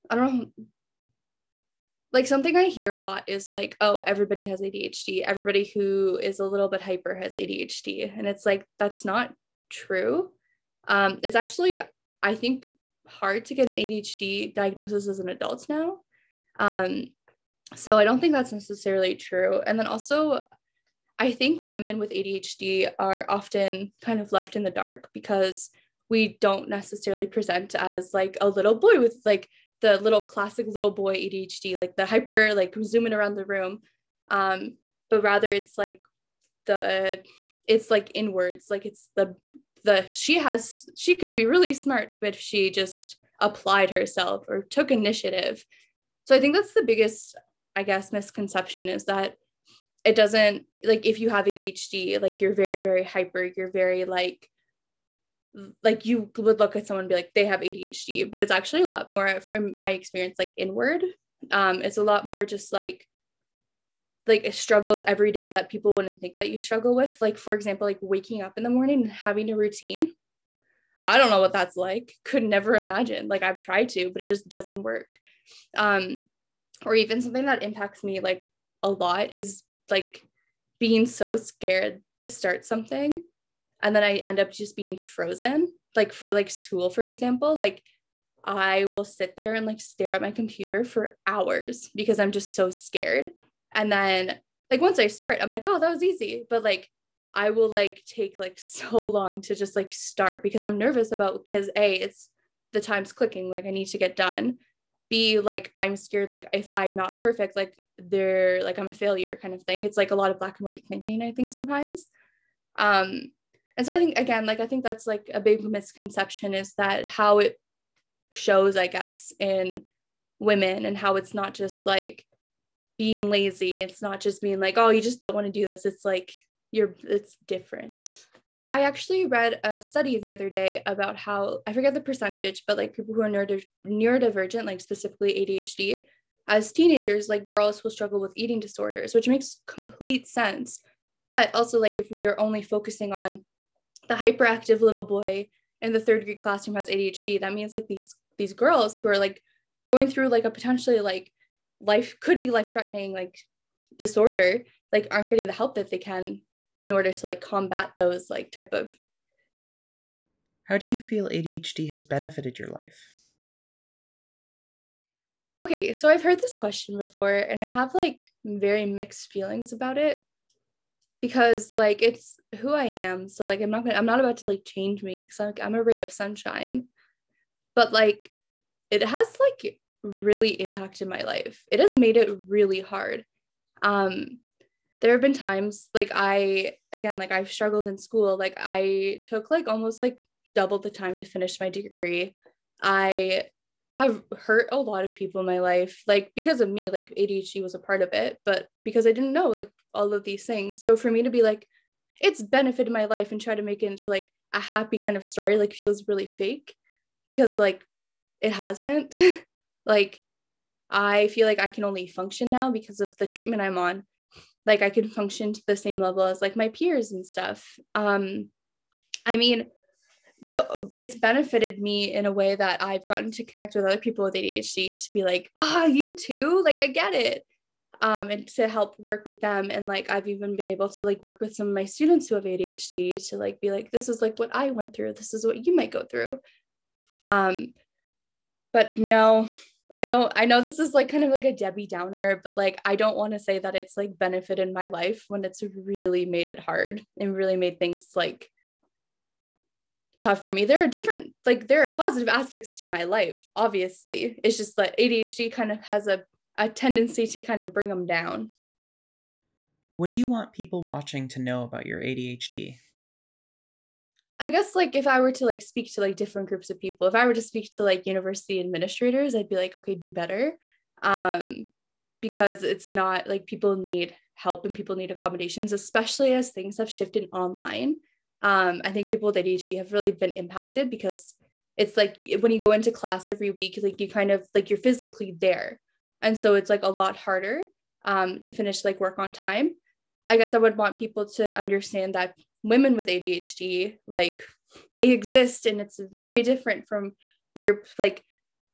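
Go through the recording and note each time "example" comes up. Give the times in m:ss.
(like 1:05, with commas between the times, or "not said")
1:07, 1:27.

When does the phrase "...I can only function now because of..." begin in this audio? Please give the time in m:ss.
3:31.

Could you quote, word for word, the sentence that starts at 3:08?
Like I took like almost like double the time to finish my degree.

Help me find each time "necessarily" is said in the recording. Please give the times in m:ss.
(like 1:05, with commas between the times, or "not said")
0:18, 0:26.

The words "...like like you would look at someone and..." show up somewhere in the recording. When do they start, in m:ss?
0:54.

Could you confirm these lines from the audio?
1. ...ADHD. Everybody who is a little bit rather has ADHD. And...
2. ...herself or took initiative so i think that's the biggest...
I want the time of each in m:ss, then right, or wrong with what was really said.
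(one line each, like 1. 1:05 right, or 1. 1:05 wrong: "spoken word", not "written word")
1. 0:04 wrong: "hyper", not "rather"
2. 0:43 right.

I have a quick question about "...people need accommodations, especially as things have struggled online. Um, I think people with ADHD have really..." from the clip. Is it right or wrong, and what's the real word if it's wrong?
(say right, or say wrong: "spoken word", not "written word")
wrong: "shifted", not "struggled".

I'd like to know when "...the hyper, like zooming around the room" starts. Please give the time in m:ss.
0:31.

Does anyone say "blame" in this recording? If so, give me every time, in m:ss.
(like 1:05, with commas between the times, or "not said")
not said.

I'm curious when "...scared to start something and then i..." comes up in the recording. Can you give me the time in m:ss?
1:21.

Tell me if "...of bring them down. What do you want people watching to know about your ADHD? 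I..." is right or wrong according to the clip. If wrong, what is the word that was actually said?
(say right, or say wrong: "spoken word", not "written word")
right.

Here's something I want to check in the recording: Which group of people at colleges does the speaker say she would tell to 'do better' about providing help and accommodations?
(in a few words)
University administrators.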